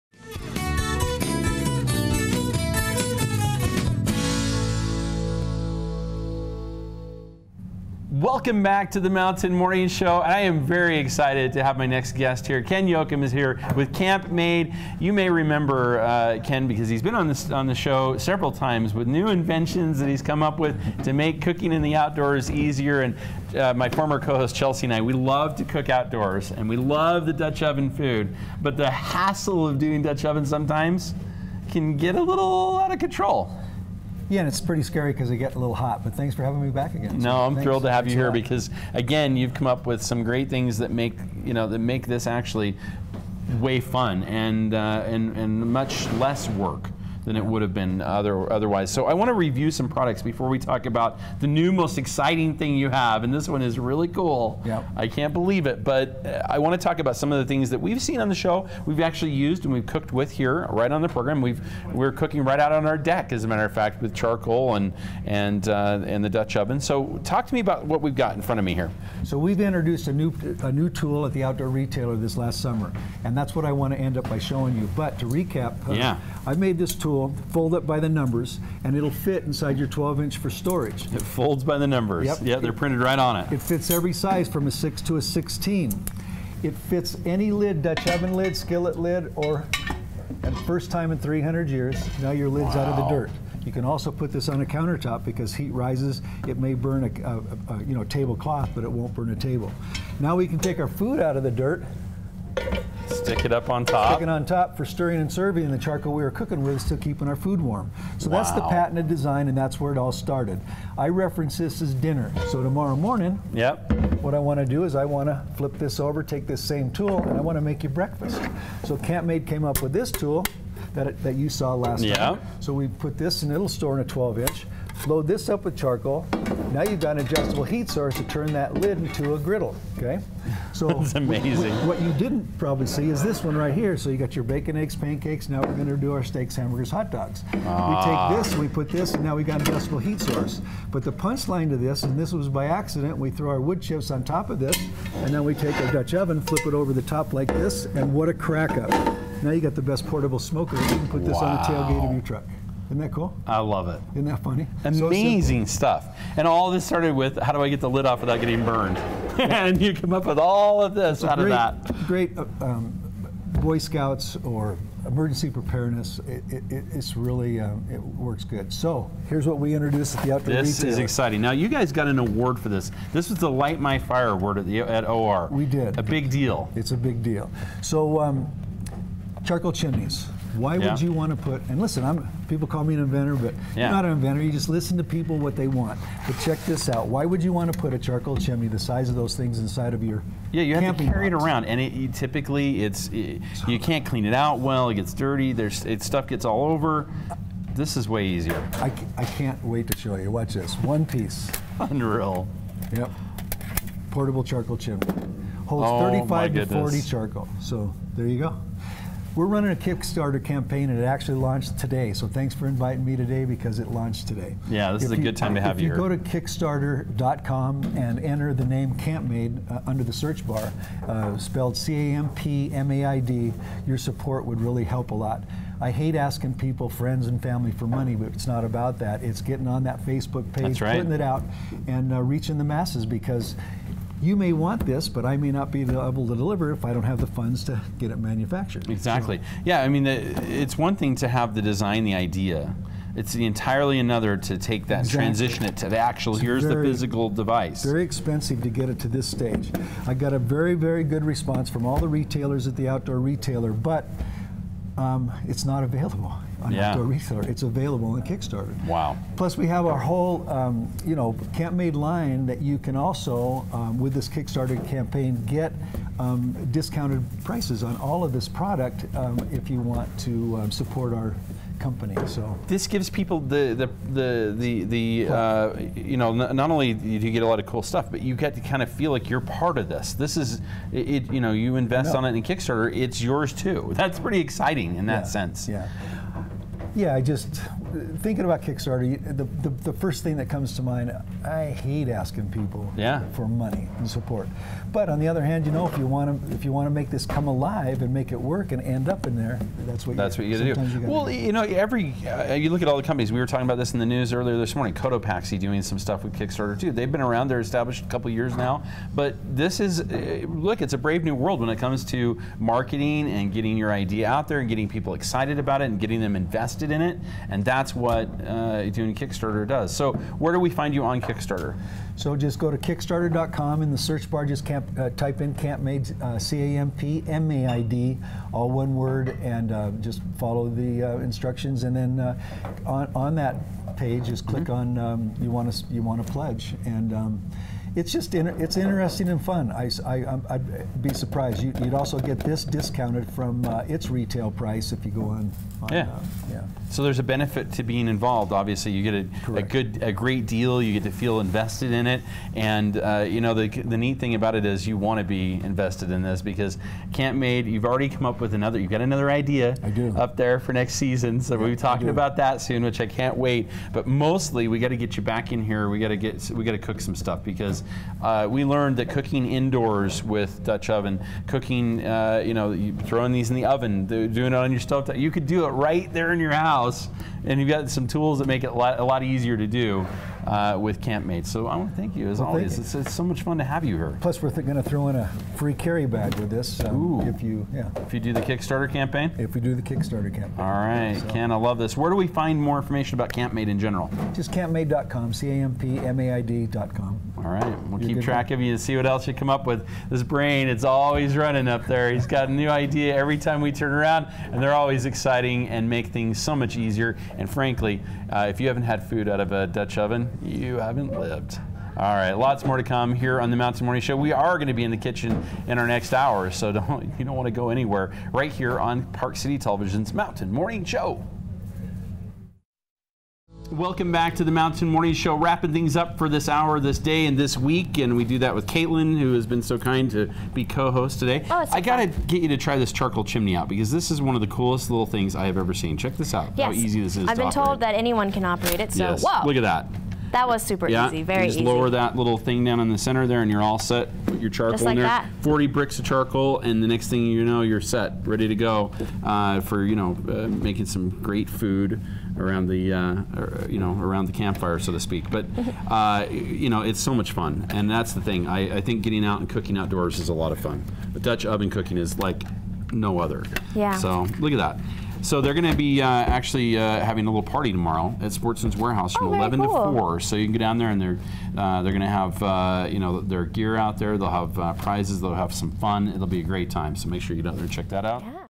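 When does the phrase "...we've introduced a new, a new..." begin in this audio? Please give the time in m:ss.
1:09.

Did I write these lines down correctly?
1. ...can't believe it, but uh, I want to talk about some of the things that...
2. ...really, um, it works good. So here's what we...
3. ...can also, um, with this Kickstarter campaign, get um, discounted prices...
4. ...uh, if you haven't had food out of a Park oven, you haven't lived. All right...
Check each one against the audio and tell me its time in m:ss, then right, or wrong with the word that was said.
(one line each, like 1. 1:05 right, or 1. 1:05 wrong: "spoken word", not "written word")
1. 0:55 right
2. 2:47 right
3. 4:22 right
4. 6:48 wrong: "Dutch", not "Park".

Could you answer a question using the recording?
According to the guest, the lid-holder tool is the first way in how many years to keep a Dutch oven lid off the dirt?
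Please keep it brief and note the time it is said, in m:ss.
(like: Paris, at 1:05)
300, at 1:31.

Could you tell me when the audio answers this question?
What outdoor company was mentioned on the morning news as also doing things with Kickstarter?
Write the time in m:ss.
5:04.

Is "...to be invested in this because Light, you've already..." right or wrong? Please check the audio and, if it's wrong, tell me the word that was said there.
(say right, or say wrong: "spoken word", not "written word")
wrong: "CampMaid", not "Light".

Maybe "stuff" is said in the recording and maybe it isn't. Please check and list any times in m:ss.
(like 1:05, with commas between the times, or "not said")
2:35, 3:16, 4:37, 5:05, 6:07.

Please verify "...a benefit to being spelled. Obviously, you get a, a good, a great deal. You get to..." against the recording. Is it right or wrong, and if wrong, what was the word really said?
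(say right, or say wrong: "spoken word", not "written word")
wrong: "involved", not "spelled".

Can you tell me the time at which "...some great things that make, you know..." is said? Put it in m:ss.
0:40.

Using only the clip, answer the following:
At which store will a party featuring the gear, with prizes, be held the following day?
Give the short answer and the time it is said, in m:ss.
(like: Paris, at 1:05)
Sportsman's Warehouse, at 7:48.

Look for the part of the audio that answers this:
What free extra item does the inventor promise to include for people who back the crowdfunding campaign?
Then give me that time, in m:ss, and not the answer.
6:25.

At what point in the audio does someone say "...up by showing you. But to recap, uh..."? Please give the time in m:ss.
1:14.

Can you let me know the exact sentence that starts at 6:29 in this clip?
If we do the Kickstarter campaign.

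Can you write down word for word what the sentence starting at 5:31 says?
And then uh, on, on that page, just click mm -hmm.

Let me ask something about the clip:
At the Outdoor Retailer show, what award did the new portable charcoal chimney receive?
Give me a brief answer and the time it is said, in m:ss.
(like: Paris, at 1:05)
Light My Fire, at 2:53.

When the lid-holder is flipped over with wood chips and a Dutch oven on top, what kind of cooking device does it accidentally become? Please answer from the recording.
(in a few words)
Portable smoker.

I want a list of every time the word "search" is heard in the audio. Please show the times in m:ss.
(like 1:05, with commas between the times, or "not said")
3:40, 5:23.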